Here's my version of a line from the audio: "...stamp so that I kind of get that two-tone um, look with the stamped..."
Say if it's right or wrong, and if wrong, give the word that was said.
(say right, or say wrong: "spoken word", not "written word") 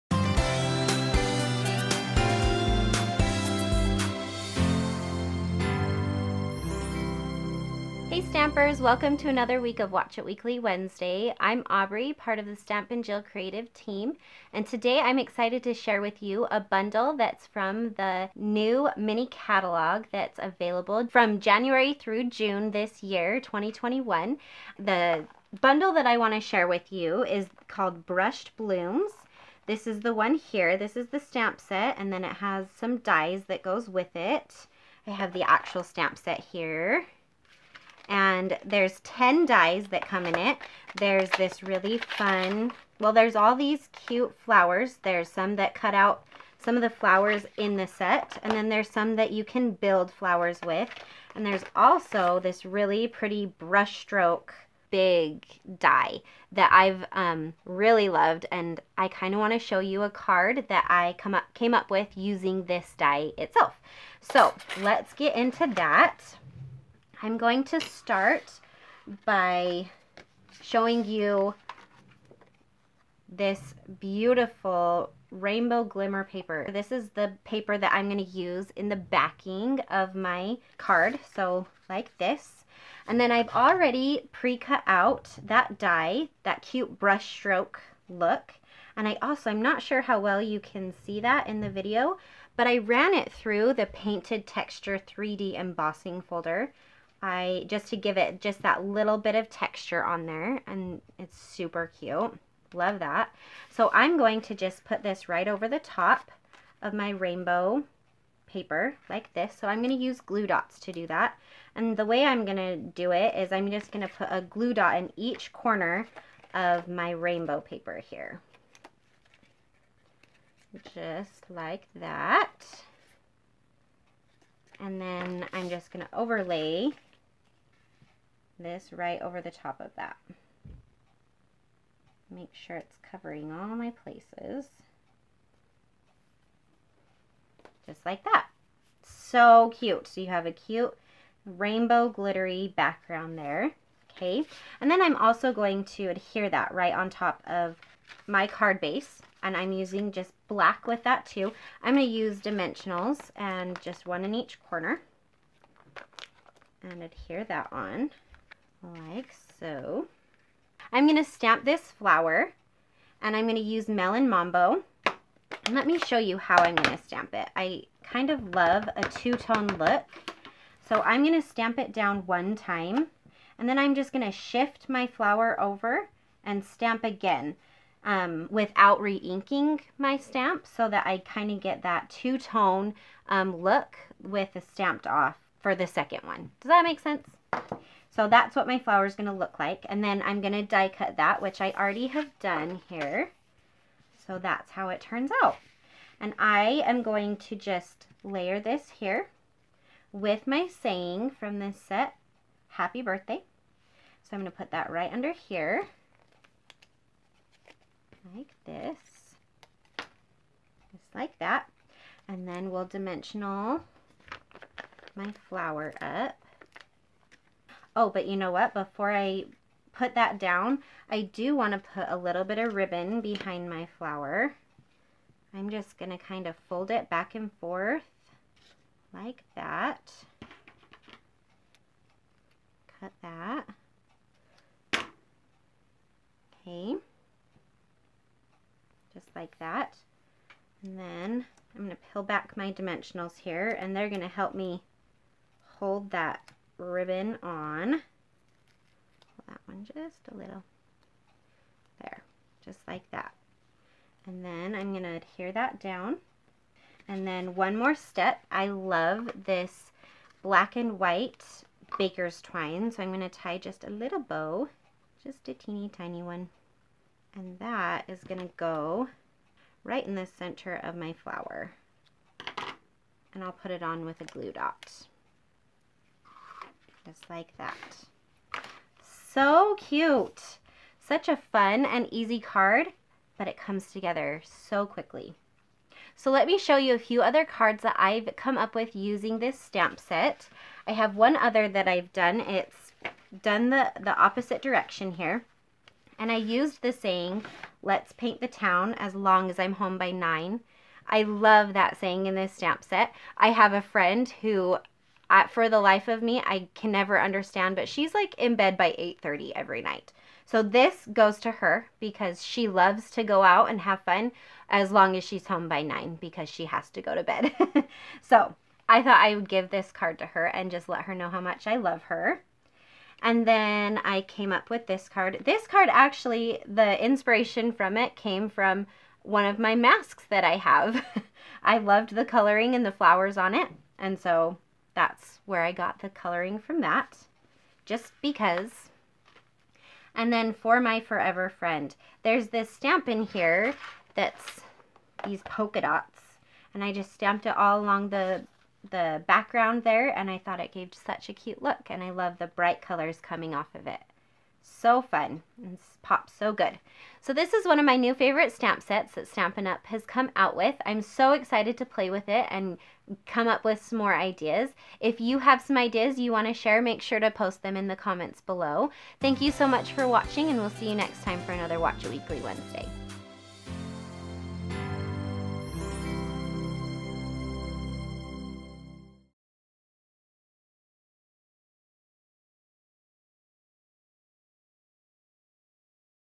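right.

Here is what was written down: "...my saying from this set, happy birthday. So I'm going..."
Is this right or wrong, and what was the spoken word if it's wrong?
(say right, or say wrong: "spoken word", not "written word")
right.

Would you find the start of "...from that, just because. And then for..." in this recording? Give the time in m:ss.
5:36.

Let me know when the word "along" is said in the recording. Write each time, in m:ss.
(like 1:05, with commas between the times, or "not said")
5:47.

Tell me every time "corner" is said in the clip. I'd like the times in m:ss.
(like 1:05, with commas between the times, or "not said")
1:55, 2:34.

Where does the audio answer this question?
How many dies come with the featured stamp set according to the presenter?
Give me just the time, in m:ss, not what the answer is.
0:39.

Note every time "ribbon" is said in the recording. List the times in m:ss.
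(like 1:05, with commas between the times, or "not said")
3:42, 4:06.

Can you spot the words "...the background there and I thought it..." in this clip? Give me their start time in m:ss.
5:48.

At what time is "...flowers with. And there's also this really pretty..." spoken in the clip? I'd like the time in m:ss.
0:50.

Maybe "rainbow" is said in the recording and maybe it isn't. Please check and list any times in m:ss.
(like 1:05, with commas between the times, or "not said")
1:15, 1:47, 1:57, 2:21.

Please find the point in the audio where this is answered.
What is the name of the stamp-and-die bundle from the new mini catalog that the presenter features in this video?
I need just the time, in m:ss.
0:28.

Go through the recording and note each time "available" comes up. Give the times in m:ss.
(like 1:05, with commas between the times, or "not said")
0:20.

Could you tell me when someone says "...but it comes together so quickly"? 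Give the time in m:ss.
4:43.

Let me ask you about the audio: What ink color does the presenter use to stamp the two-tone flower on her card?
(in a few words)
Melon Mambo.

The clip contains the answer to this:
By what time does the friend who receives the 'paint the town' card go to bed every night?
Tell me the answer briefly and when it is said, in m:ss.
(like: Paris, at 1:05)
8:30, at 5:08.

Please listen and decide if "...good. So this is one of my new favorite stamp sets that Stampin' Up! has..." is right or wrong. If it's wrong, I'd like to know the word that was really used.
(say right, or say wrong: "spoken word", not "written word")
right.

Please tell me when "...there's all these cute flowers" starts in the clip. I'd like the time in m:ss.
0:43.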